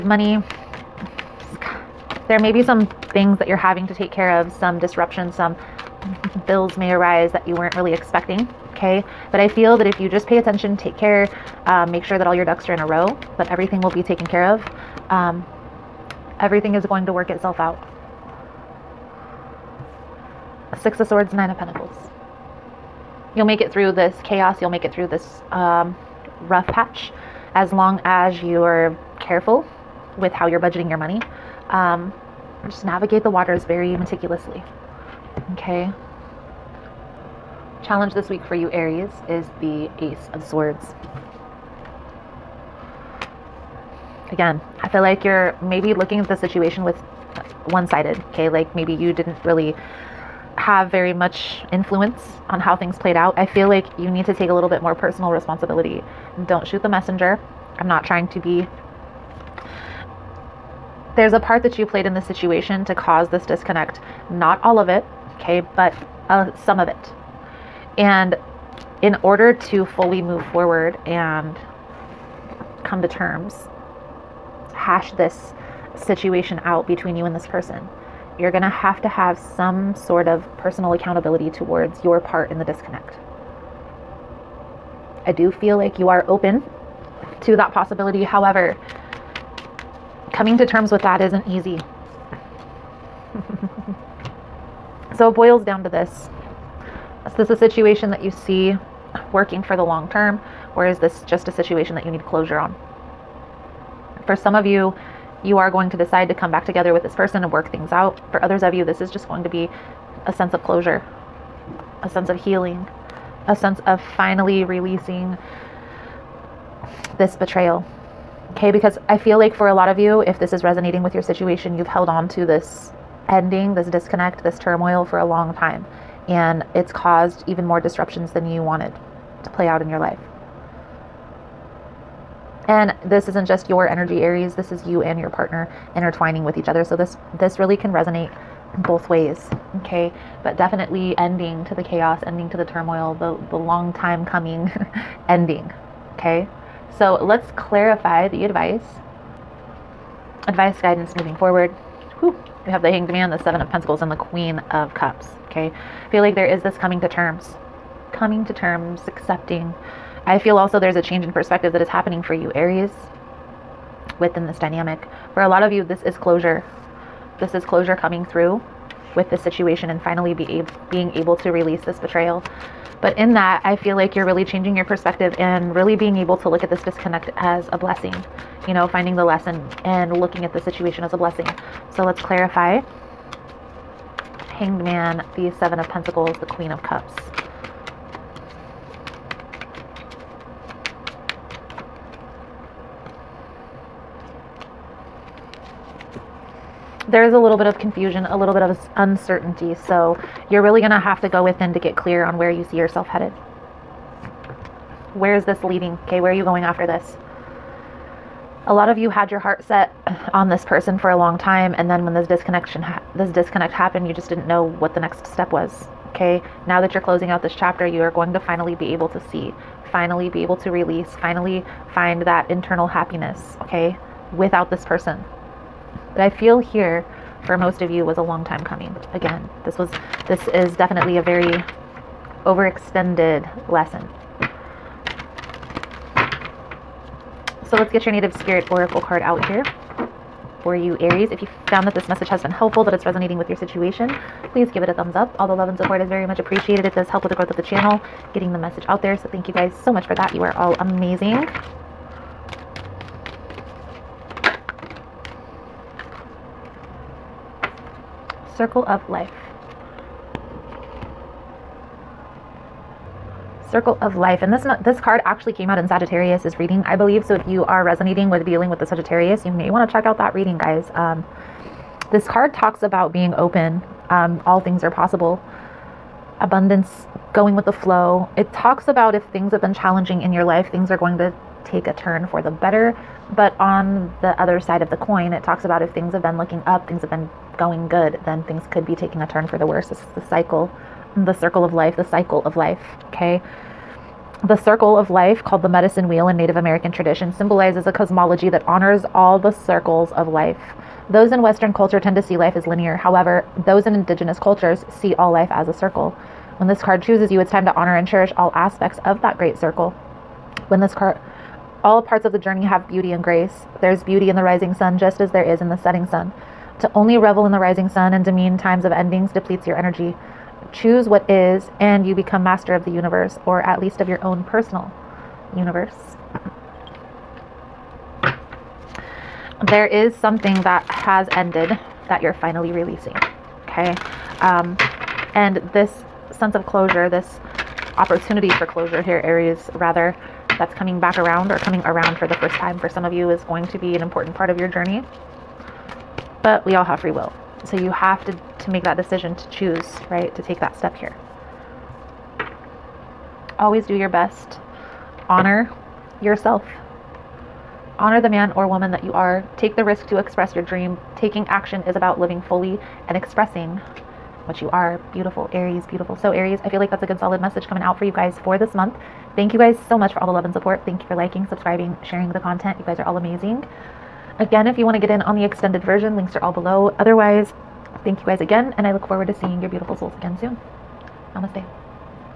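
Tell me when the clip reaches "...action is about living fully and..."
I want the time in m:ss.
6:01.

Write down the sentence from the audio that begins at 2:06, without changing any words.
And it's caused even more disruptions than you wanted to play out in your life.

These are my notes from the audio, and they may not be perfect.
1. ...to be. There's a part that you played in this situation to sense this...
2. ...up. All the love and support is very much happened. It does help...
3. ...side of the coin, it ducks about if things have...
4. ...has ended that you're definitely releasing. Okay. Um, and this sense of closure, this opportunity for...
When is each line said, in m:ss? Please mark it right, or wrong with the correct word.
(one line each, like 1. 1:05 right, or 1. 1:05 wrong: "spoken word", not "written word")
1. 0:58 wrong: "cause", not "sense"
2. 4:05 wrong: "appreciated", not "happened"
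3. 4:44 wrong: "talks", not "ducks"
4. 5:30 wrong: "finally", not "definitely".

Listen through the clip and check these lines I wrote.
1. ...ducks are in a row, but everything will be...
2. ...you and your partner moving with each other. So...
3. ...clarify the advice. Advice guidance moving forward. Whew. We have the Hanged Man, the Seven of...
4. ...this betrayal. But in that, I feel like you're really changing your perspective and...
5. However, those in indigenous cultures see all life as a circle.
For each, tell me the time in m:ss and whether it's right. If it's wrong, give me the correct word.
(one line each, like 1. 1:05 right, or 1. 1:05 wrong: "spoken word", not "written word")
1. 0:12 right
2. 2:14 wrong: "intertwining", not "moving"
3. 2:27 right
4. 2:51 right
5. 5:02 right.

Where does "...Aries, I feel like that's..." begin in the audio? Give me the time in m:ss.
6:06.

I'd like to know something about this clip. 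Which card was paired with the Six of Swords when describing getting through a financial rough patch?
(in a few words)
Nine of Pentacles.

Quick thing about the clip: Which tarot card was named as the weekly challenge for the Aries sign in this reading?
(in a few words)
Ace of Swords.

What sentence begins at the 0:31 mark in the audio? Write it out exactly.
Um, just navigate the waters very meticulously.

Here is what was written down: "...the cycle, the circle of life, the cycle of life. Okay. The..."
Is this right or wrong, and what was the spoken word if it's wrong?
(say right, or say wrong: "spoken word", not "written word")
right.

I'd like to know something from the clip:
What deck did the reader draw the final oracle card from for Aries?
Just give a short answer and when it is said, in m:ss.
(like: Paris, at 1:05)
Native Spirit Oracle, at 3:58.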